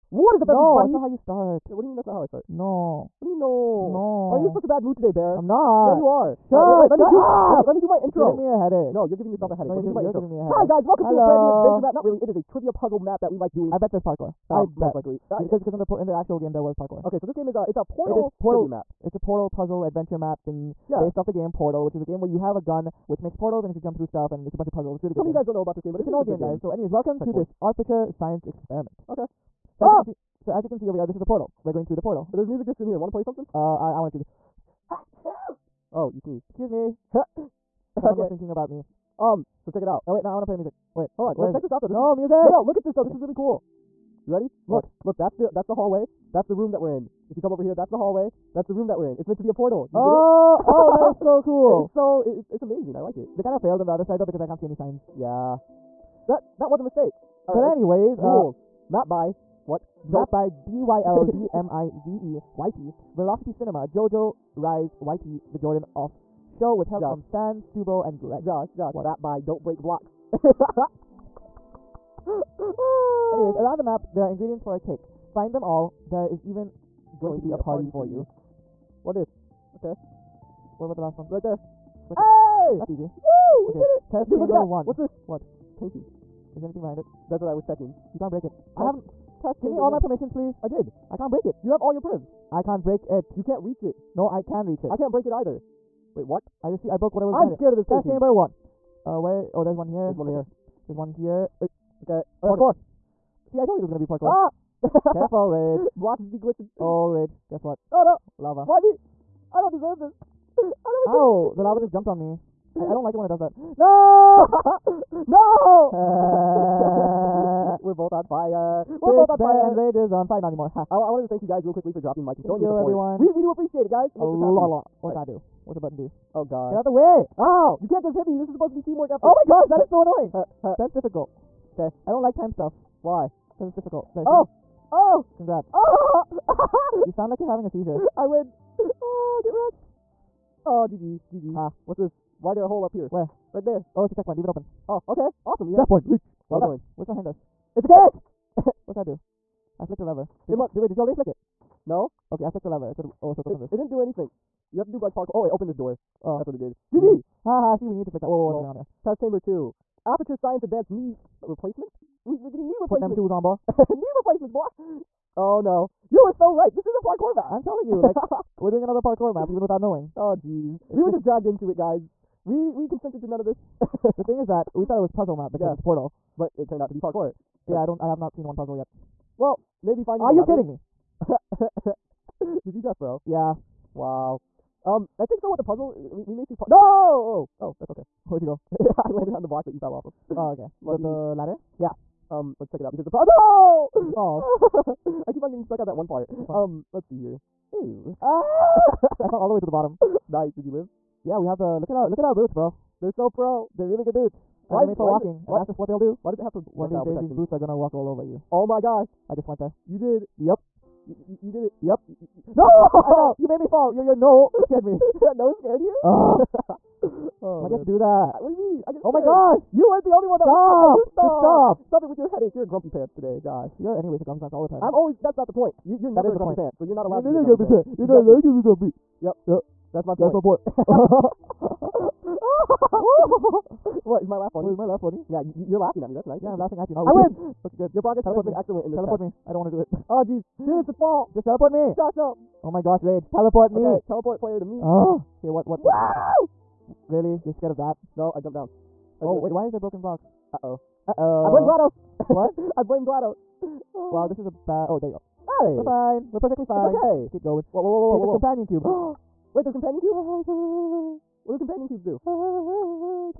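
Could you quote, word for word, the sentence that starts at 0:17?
Okay, so this game is a uh, it's a portal.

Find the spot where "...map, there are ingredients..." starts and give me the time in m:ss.
1:13.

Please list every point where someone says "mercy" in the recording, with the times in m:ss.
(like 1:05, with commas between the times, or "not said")
not said.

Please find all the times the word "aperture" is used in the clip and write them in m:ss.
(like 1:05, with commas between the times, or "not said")
0:27, 2:40.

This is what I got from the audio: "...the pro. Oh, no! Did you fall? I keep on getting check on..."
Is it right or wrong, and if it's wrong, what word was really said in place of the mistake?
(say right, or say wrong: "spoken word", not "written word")
wrong: "stuck", not "check".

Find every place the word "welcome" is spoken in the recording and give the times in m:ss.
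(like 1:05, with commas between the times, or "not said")
0:10, 0:26.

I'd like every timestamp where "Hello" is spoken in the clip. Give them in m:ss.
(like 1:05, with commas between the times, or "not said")
0:11.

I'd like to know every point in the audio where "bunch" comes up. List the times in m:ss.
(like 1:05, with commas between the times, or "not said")
0:24.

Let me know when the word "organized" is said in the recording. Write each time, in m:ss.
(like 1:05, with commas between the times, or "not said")
not said.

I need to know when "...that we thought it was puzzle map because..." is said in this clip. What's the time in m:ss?
2:54.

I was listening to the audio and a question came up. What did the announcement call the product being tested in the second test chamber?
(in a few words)
advanced knee replacement.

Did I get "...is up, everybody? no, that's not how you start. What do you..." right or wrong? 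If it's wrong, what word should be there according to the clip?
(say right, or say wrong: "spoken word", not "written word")
right.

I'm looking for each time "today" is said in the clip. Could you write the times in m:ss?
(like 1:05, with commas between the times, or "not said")
0:04, 3:43.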